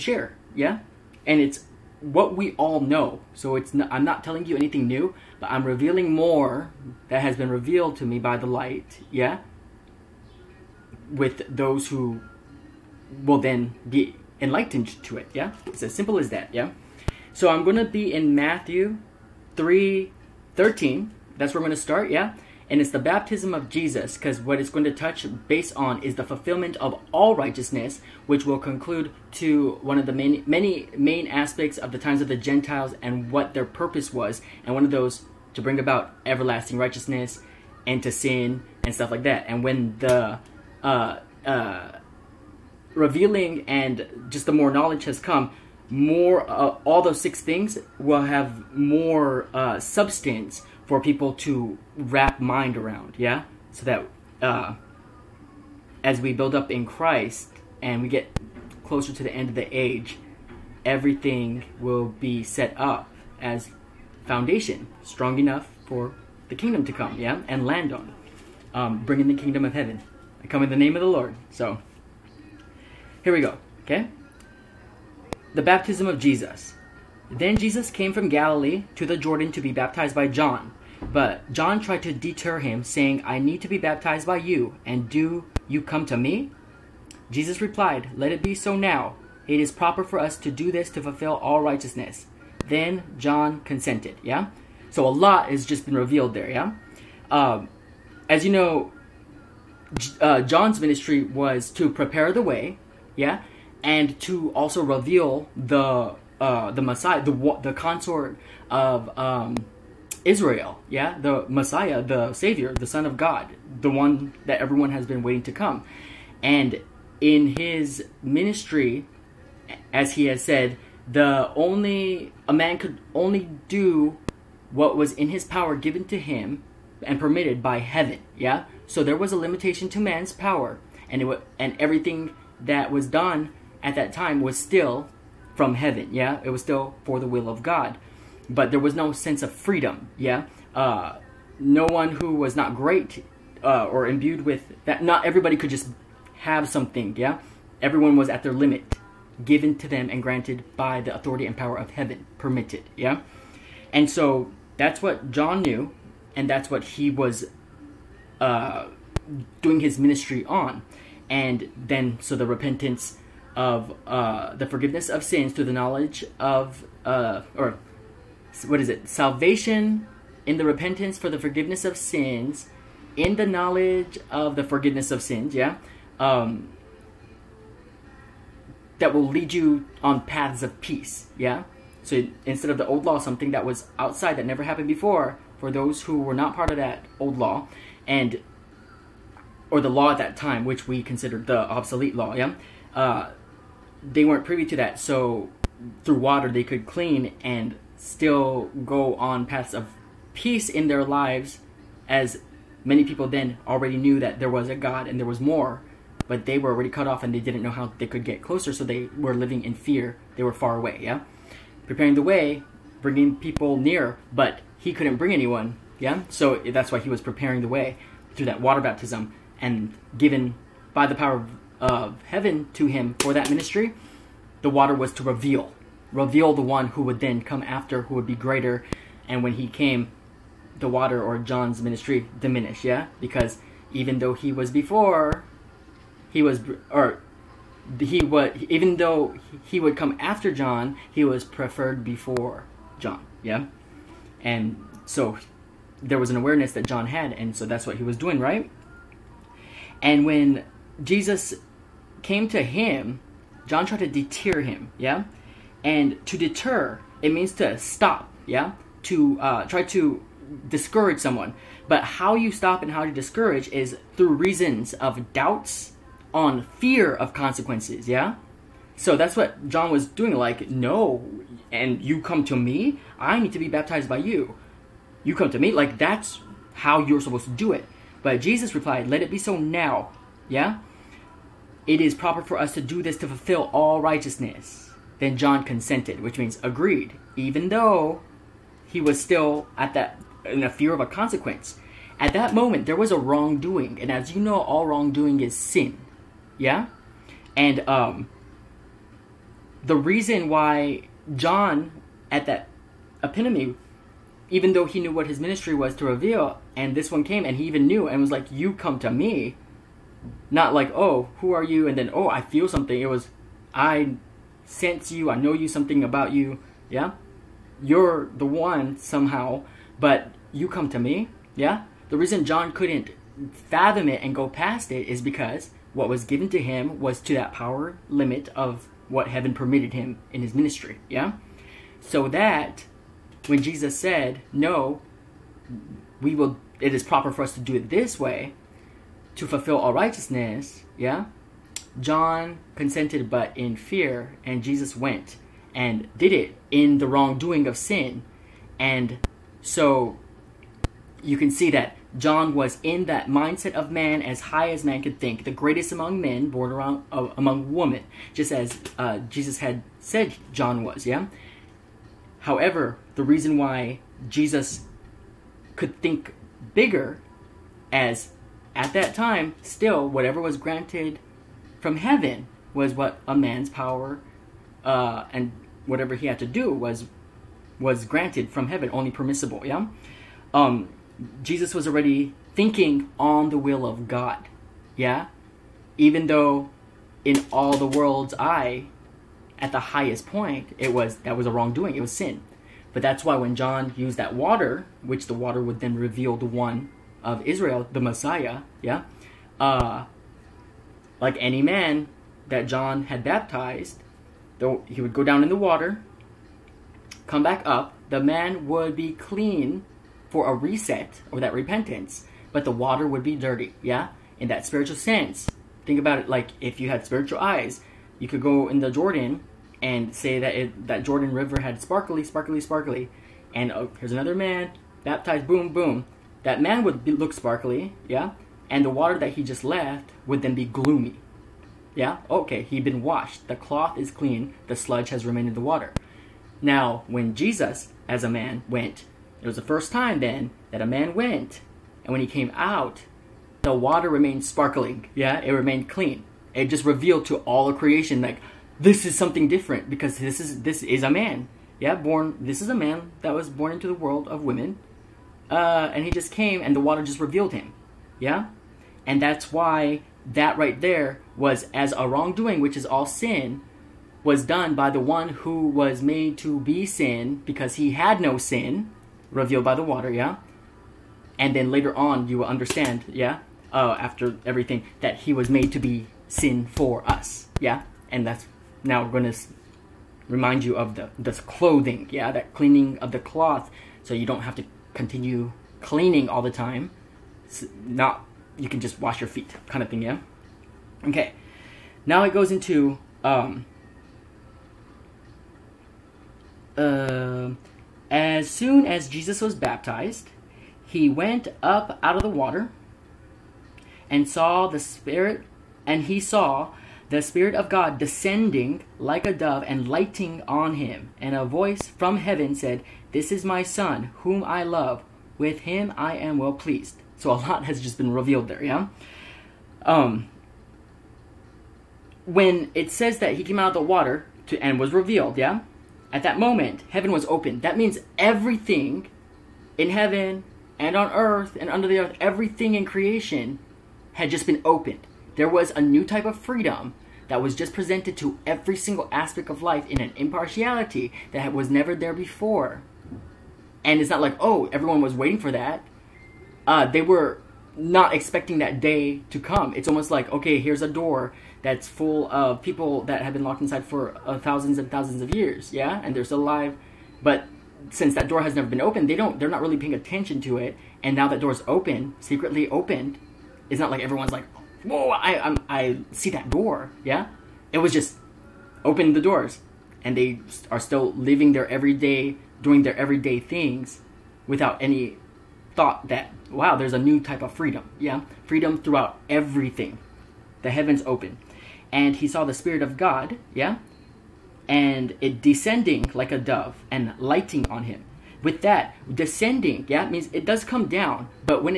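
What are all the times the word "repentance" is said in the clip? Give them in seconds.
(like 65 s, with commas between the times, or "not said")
162 s, 170 s, 411 s.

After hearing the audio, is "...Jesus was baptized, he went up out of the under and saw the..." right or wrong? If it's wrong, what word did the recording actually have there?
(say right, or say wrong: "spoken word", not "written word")
wrong: "water", not "under".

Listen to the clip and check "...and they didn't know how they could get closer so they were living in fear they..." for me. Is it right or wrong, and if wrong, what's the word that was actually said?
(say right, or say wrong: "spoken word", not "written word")
right.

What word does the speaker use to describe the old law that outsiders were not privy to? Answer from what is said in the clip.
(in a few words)
obsolete.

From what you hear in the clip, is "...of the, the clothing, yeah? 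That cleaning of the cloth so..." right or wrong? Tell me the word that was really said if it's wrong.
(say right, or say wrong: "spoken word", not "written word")
right.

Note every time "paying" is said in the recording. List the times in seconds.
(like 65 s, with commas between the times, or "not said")
559 s.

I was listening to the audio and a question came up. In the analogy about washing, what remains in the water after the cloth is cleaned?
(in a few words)
sludge.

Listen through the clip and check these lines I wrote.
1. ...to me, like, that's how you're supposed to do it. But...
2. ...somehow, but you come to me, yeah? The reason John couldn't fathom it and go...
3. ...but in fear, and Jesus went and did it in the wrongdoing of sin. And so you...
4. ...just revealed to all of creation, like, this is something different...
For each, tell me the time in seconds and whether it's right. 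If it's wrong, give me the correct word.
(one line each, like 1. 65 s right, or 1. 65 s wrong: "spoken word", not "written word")
1. 275 s right
2. 318 s right
3. 343 s right
4. 446 s right.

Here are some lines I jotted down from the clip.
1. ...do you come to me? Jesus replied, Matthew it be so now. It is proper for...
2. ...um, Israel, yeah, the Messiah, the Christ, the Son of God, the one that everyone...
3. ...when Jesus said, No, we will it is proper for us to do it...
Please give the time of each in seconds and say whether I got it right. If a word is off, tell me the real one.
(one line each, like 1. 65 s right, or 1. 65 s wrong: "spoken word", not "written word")
1. 85 s wrong: "Let", not "Matthew"
2. 109 s wrong: "Savior", not "Christ"
3. 333 s right.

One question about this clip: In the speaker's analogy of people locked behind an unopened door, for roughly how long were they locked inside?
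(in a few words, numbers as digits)
thousands of years.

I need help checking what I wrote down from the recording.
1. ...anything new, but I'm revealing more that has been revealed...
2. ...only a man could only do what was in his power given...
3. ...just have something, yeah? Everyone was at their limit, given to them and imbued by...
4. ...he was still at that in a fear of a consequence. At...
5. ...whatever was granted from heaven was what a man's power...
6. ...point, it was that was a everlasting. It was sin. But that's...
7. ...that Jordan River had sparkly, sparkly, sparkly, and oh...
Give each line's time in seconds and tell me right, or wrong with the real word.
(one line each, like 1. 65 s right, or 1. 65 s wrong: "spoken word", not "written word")
1. 4 s right
2. 121 s right
3. 145 s wrong: "granted", not "imbued"
4. 288 s right
5. 370 s right
6. 390 s wrong: "wrongdoing", not "everlasting"
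7. 420 s right.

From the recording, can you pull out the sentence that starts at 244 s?
And so there was an awareness that John had, and so that's what he was doing, right?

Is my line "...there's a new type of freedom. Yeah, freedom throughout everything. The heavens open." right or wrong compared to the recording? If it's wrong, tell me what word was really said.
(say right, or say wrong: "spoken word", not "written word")
right.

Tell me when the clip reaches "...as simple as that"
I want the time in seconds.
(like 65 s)
15 s.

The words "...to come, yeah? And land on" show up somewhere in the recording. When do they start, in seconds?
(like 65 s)
66 s.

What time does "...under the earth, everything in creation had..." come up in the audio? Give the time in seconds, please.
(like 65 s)
531 s.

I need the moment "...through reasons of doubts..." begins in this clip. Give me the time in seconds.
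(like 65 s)
264 s.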